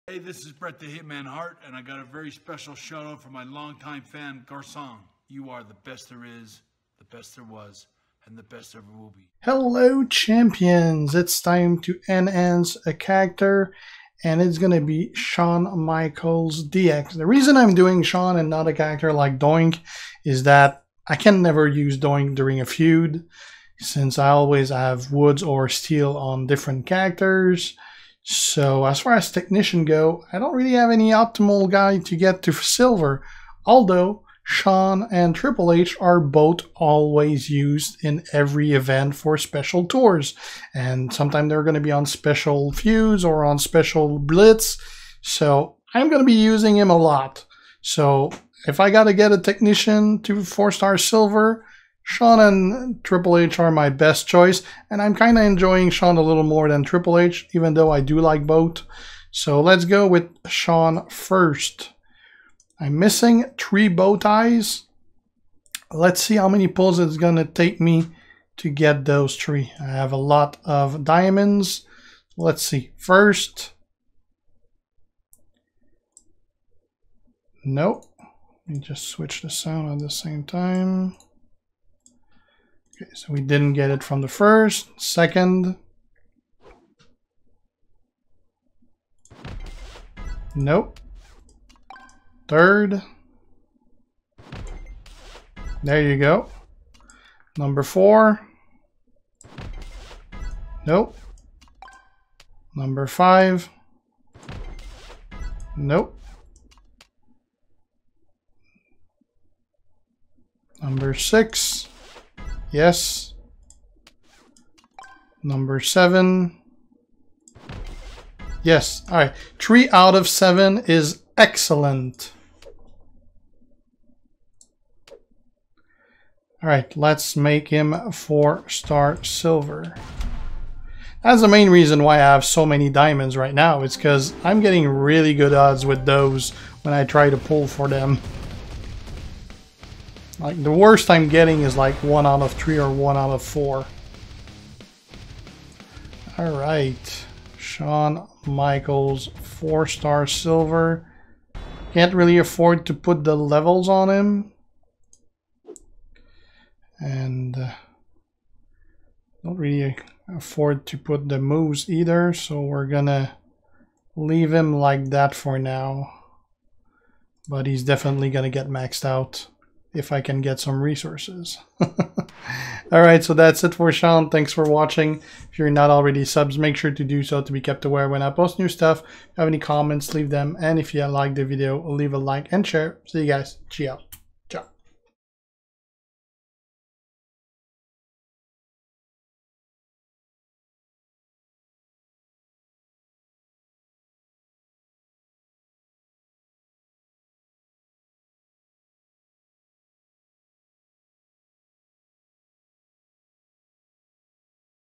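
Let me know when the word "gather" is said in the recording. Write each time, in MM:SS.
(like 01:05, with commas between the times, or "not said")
not said.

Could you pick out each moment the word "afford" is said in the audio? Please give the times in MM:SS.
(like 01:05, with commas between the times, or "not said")
02:32, 02:40.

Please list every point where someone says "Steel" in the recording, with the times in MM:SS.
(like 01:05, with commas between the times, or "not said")
00:25.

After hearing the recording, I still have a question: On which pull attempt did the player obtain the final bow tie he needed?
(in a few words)
7.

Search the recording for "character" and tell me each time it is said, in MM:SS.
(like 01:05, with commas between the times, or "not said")
00:12, 00:18, 00:26.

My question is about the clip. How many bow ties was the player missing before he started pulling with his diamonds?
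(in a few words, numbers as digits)
3.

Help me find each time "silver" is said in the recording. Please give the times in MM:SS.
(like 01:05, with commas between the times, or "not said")
00:32, 00:50, 02:09, 02:30.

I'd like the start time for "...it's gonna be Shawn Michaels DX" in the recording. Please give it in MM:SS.
00:14.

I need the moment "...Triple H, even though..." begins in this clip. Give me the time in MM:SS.
00:56.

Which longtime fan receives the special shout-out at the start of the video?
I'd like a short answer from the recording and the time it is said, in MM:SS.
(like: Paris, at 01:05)
Guersan, at 00:04.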